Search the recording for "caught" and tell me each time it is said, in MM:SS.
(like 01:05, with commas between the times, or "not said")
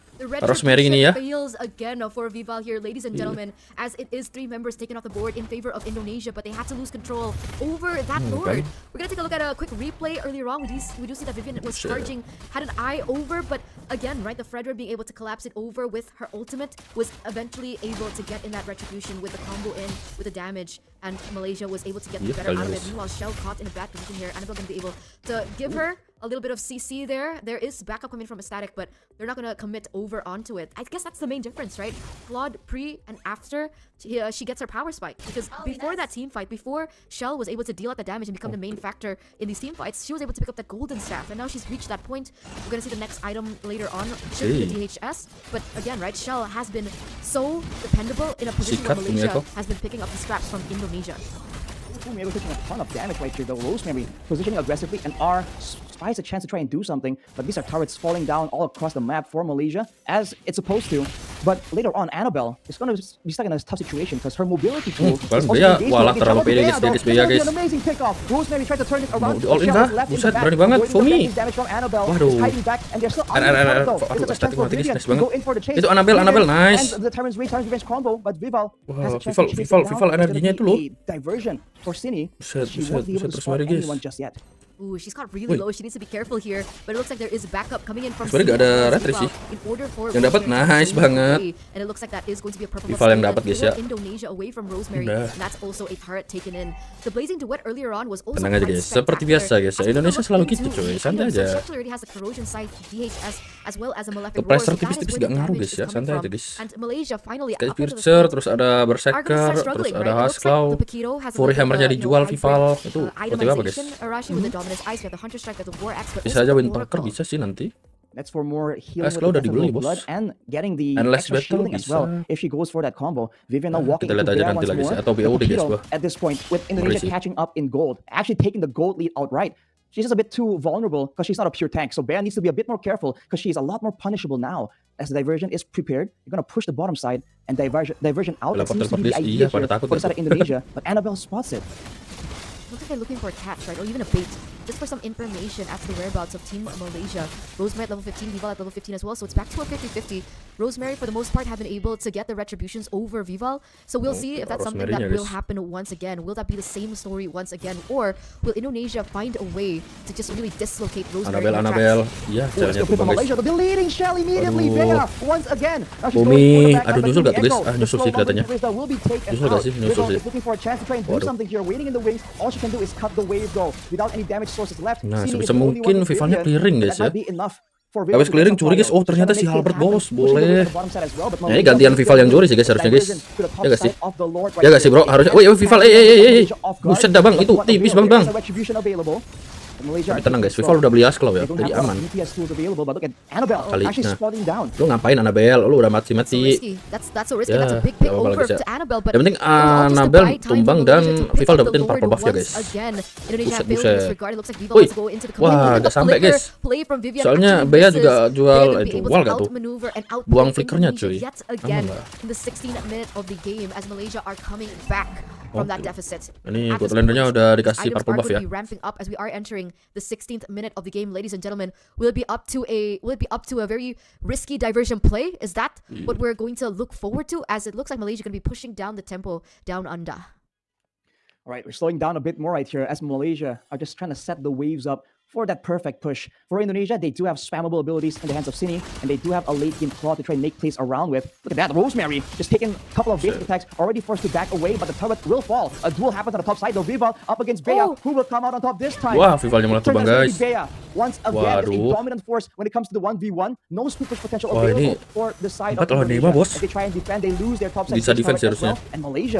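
00:23, 01:25.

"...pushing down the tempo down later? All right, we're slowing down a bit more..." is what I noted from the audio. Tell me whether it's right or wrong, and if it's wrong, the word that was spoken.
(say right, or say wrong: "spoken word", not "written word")
wrong: "under", not "later".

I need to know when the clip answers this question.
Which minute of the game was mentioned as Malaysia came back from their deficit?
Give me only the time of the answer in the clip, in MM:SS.
03:32.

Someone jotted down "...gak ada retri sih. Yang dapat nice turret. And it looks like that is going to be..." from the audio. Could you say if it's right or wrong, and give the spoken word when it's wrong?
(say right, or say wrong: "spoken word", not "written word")
wrong: "banget", not "turret".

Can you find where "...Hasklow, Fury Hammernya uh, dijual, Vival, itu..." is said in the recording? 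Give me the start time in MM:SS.
01:50.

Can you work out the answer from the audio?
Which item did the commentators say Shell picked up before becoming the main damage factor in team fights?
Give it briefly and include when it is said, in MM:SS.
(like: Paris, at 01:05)
Golden Staff, at 00:40.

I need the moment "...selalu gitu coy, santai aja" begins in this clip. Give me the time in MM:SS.
01:40.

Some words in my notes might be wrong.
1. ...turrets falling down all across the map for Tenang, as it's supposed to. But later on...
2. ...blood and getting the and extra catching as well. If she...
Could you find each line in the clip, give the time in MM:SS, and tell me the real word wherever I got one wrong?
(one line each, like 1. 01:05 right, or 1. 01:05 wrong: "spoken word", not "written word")
1. 00:57 wrong: "Malaysia", not "Tenang"
2. 01:59 wrong: "shielding", not "catching".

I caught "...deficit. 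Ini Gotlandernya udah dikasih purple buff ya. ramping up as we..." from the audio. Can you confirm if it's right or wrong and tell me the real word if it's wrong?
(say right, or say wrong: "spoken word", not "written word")
right.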